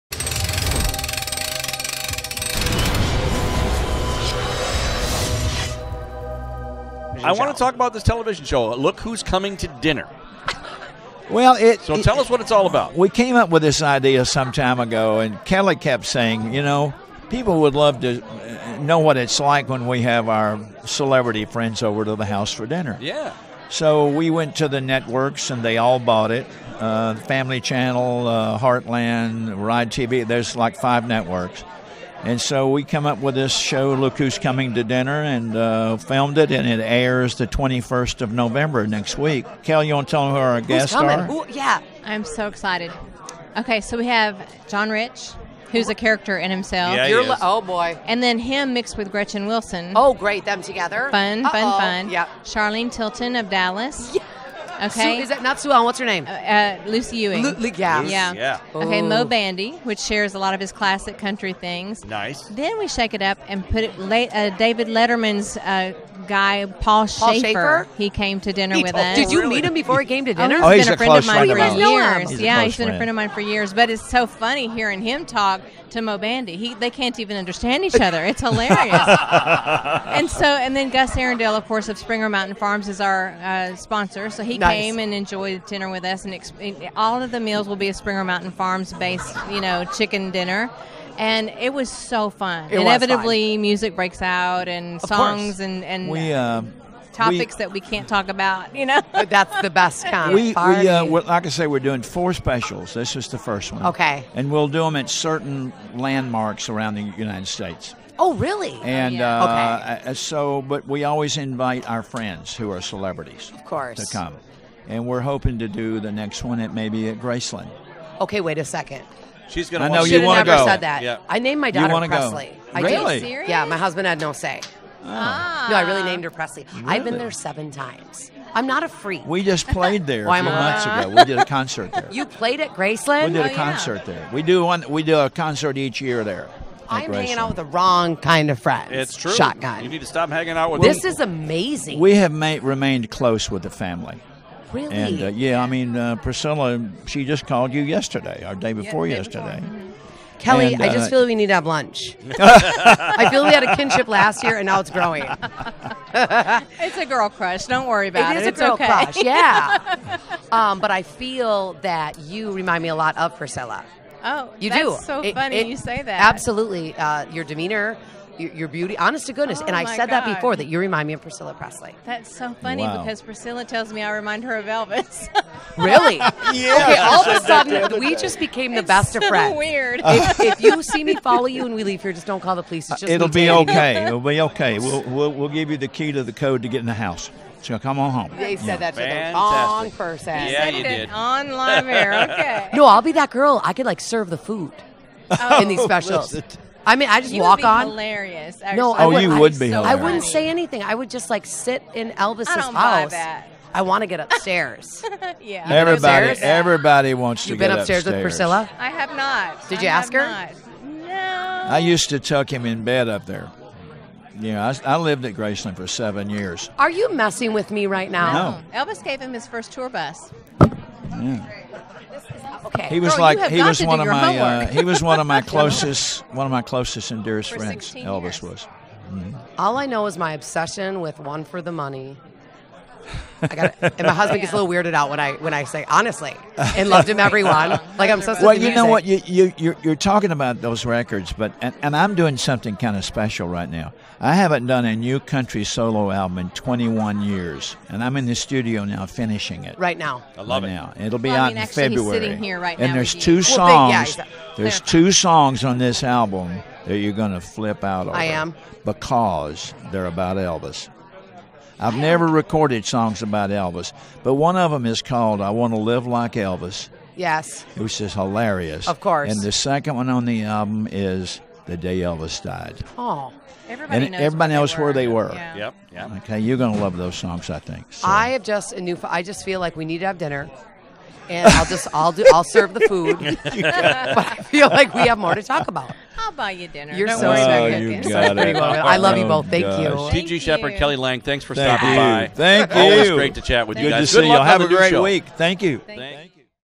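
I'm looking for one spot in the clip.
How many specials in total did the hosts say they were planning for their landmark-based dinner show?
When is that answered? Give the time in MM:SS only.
01:42.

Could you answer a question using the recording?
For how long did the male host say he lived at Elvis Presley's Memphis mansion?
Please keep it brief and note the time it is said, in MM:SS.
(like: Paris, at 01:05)
7 years, at 03:35.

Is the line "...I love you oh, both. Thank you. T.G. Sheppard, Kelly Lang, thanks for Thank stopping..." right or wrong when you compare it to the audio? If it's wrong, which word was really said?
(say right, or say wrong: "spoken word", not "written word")
right.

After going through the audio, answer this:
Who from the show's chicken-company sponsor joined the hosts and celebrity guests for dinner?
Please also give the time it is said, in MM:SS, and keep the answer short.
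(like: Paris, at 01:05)
Gus Arrendale, at 01:20.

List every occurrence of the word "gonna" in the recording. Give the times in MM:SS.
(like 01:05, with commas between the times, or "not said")
01:59, 04:36.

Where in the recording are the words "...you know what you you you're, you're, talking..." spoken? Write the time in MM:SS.
03:58.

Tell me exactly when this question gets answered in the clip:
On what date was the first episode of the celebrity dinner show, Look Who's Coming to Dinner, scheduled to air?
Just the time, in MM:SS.
00:37.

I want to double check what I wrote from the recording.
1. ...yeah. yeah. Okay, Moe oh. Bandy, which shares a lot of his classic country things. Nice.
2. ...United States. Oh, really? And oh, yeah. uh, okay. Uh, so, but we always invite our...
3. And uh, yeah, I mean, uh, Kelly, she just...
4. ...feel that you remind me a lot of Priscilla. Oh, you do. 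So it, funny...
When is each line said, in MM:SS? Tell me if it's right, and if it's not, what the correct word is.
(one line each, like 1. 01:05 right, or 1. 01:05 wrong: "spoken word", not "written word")
1. 00:57 right
2. 01:47 right
3. 02:24 wrong: "Priscilla", not "Kelly"
4. 02:41 right.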